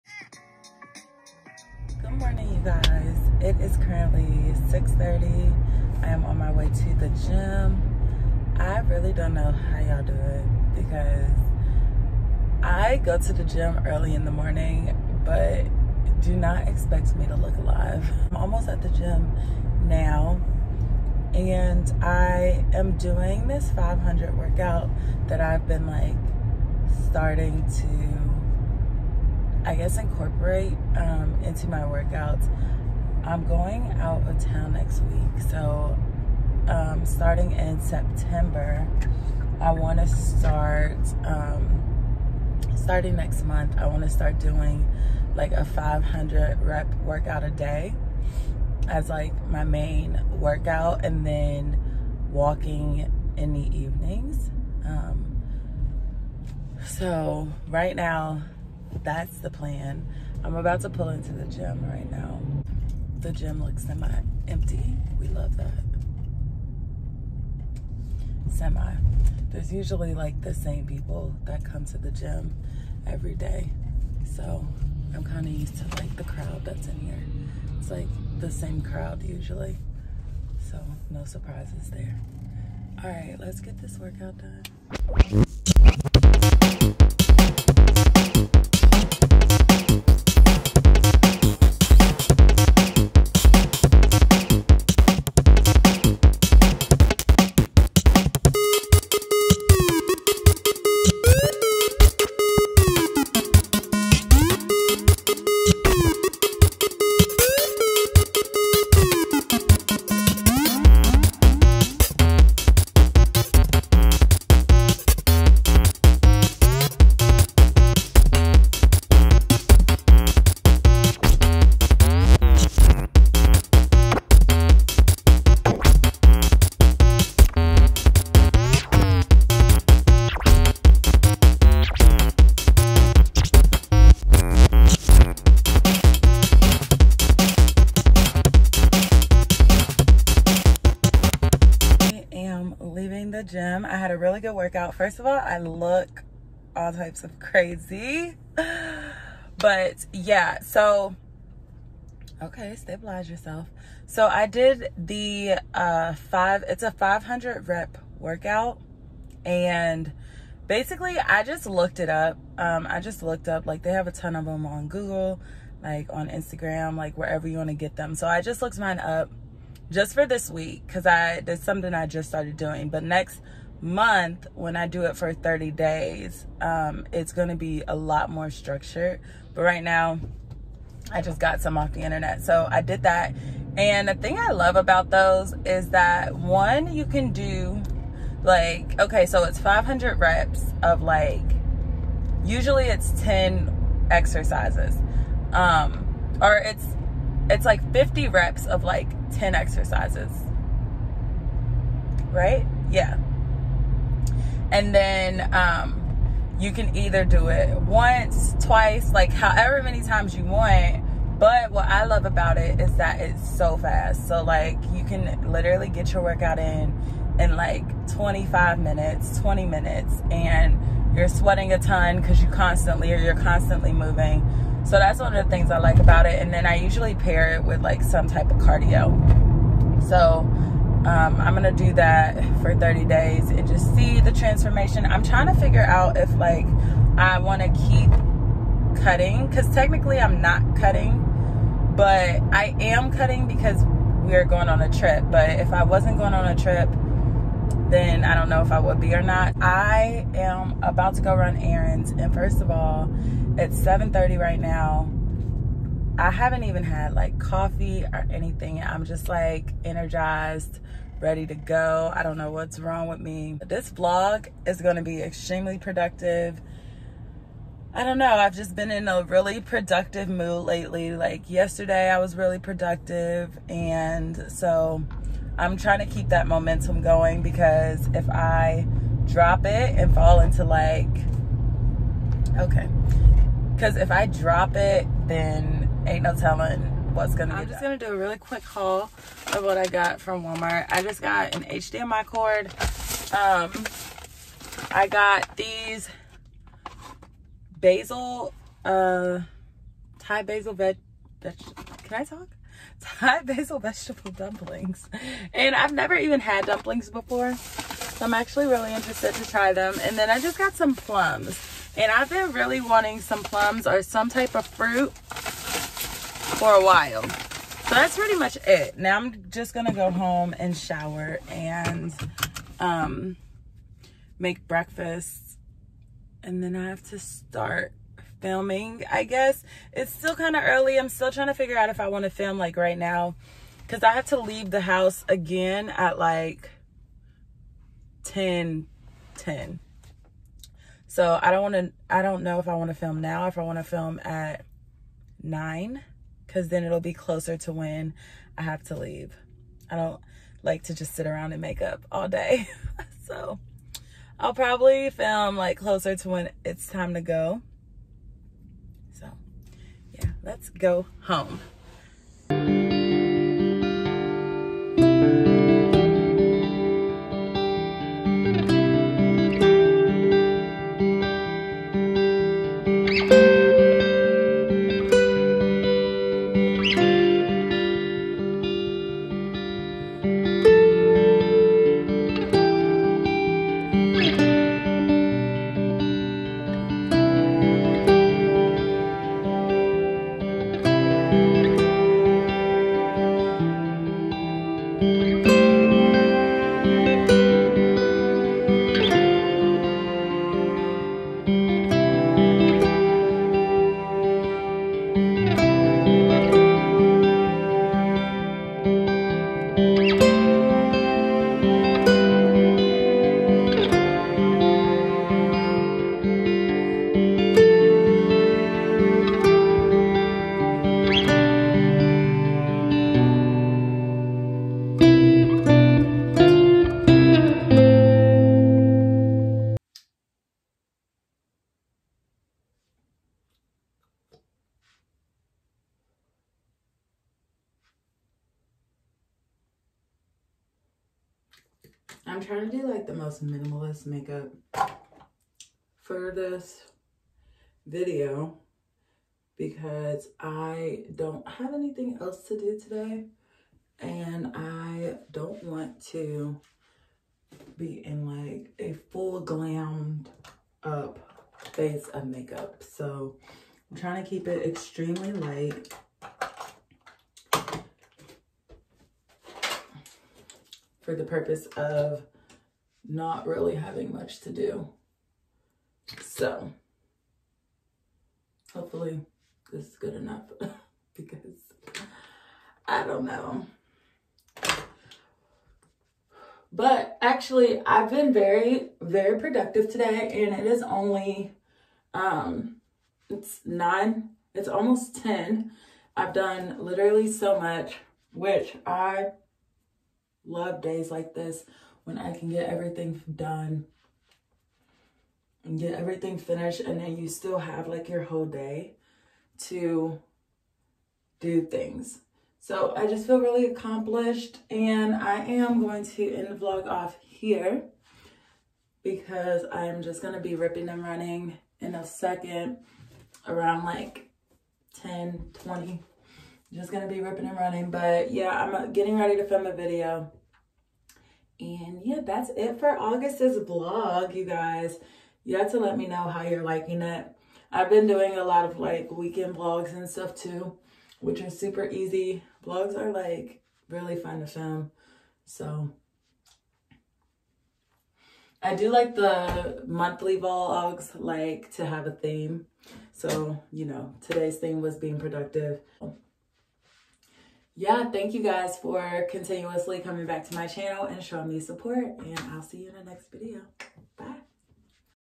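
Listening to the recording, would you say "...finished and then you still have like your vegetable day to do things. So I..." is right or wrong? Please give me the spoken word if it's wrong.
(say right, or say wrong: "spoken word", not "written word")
wrong: "whole", not "vegetable".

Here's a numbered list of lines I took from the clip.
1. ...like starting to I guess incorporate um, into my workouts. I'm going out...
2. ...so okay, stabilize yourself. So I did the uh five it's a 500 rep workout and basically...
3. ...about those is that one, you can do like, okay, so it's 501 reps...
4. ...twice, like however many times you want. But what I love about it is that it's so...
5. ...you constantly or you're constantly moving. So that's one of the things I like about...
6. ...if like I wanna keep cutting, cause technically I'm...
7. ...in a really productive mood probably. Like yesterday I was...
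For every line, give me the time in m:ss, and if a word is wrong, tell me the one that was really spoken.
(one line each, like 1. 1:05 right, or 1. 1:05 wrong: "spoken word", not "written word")
1. 0:25 right
2. 2:30 right
3. 3:04 wrong: "500", not "501"
4. 3:28 right
5. 3:42 right
6. 3:56 right
7. 4:28 wrong: "lately", not "probably".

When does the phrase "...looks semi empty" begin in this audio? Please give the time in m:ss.
1:03.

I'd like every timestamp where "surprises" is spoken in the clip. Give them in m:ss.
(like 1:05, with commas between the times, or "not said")
1:21.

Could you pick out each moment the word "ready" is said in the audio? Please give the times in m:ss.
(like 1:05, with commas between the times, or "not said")
4:21, 8:49.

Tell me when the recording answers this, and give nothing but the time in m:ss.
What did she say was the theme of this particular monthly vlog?
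9:14.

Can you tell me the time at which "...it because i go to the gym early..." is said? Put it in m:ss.
0:10.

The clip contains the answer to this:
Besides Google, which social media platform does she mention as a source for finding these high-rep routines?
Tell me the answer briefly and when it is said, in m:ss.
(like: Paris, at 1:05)
Instagram, at 2:46.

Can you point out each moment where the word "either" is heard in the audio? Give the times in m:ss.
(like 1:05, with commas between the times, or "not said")
3:26.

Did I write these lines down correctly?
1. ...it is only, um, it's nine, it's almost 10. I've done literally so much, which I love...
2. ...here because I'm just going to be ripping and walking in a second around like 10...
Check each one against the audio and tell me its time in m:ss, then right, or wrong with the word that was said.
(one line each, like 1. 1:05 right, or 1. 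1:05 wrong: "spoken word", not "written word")
1. 8:10 right
2. 8:37 wrong: "running", not "walking".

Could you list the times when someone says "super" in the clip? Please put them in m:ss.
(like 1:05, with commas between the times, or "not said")
9:01.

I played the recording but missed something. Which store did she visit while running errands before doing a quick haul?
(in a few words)
Walmart.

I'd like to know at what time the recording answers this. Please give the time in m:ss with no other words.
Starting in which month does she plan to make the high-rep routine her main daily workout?
0:37.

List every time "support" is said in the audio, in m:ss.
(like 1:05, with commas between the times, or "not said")
9:21.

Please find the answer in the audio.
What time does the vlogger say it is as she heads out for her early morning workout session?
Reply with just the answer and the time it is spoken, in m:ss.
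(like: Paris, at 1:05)
6:30, at 0:04.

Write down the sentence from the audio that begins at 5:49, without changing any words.
I don't like to just sit around and make up all day.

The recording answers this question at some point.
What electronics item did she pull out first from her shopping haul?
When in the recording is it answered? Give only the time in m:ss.
4:51.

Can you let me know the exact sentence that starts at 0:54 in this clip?
Um, so right now that's the plan.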